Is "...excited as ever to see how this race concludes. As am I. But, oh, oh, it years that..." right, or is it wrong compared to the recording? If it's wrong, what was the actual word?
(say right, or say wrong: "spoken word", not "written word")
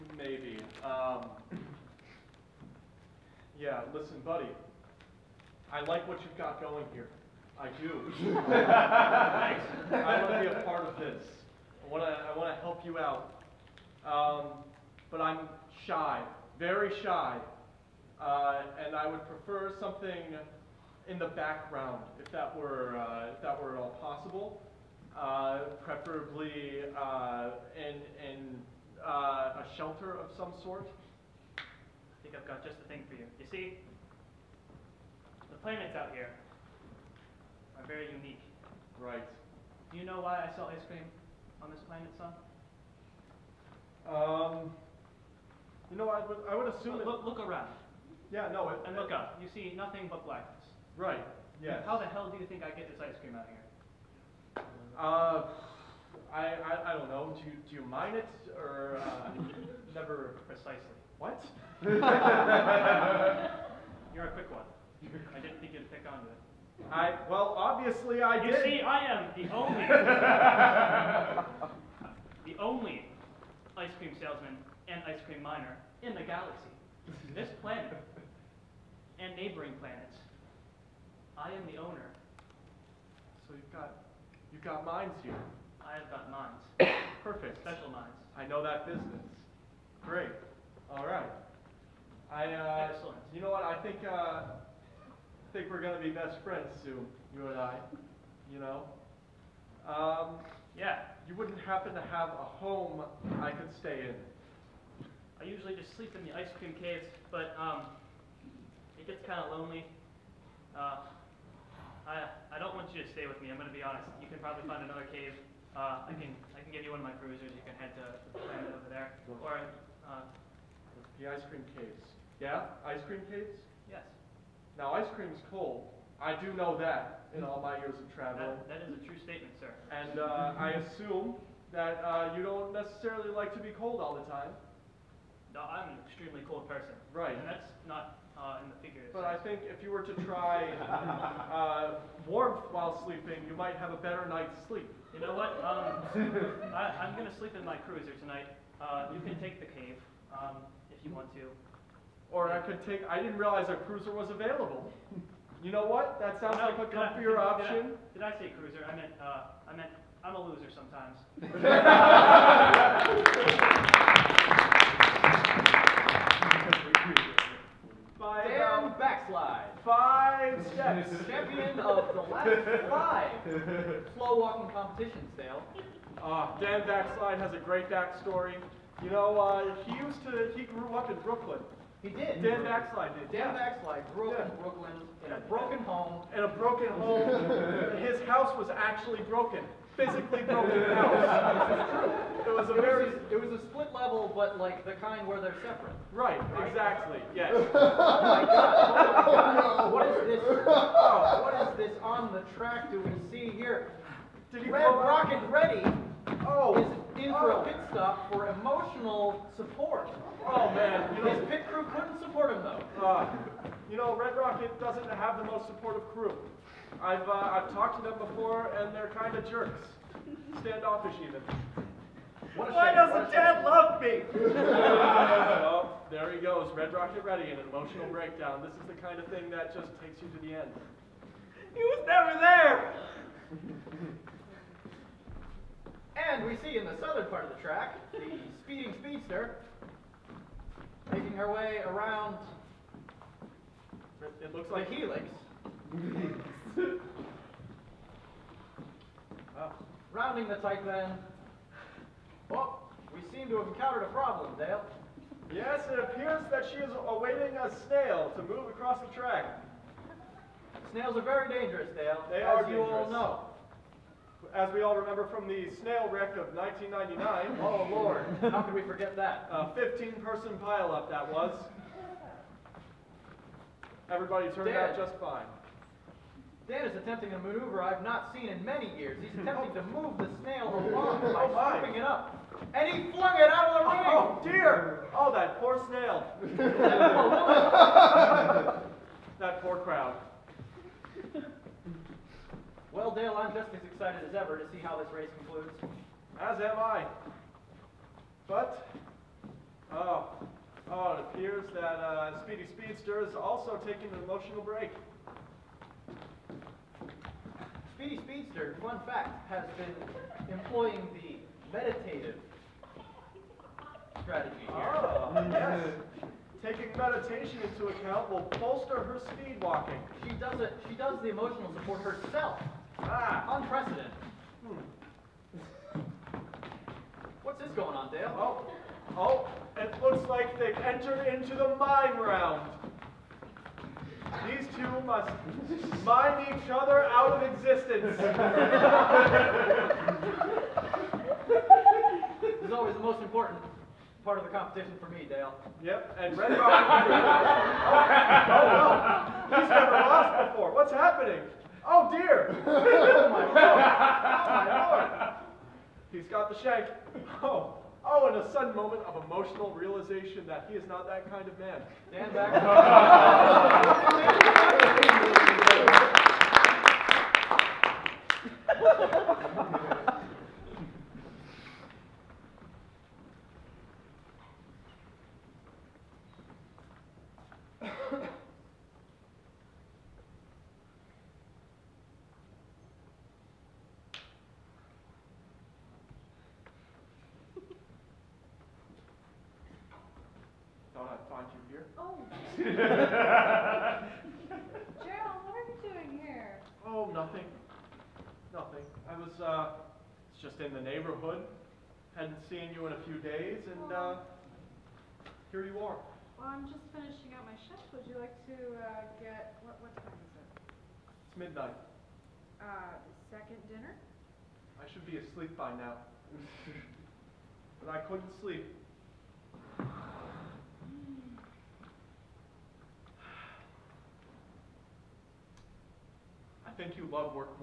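wrong: "appears", not "years".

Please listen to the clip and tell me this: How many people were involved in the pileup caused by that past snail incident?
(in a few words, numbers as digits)
15.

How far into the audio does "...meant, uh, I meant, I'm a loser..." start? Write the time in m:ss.
2:38.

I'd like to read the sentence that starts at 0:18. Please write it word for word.
Uh, and I would prefer something in the background, if that were, uh, if that were at all possible.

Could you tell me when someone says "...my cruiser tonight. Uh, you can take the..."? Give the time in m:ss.
2:27.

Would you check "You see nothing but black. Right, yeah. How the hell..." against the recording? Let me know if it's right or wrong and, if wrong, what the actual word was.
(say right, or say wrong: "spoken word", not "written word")
right.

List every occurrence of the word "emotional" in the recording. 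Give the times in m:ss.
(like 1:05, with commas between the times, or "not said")
3:28, 3:47, 5:04, 5:21, 5:59.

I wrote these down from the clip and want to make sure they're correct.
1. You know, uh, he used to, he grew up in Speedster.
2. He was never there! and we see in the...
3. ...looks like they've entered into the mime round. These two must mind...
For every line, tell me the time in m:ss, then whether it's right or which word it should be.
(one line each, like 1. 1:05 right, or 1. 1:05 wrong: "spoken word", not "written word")
1. 2:59 wrong: "Brooklyn", not "Speedster"
2. 3:51 right
3. 5:30 right.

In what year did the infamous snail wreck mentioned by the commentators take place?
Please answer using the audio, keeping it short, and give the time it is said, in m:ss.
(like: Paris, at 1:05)
1999, at 4:26.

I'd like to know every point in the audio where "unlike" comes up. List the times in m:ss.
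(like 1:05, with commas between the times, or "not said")
not said.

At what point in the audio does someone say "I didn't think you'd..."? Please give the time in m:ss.
1:05.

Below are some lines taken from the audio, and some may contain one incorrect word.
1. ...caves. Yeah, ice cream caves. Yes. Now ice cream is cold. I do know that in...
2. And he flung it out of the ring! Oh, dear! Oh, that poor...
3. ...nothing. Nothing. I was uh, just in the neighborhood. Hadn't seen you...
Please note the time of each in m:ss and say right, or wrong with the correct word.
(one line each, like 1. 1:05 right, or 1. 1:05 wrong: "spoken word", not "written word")
1. 2:01 right
2. 4:42 right
3. 6:37 right.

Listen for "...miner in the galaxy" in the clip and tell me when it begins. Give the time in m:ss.
1:15.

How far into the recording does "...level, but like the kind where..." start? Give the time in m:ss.
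3:13.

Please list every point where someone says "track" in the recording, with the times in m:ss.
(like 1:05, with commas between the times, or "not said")
3:22, 3:57, 4:19.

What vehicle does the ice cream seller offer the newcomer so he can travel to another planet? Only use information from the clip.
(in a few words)
A cruiser.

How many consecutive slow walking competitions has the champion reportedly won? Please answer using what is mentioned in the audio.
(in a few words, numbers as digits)
5.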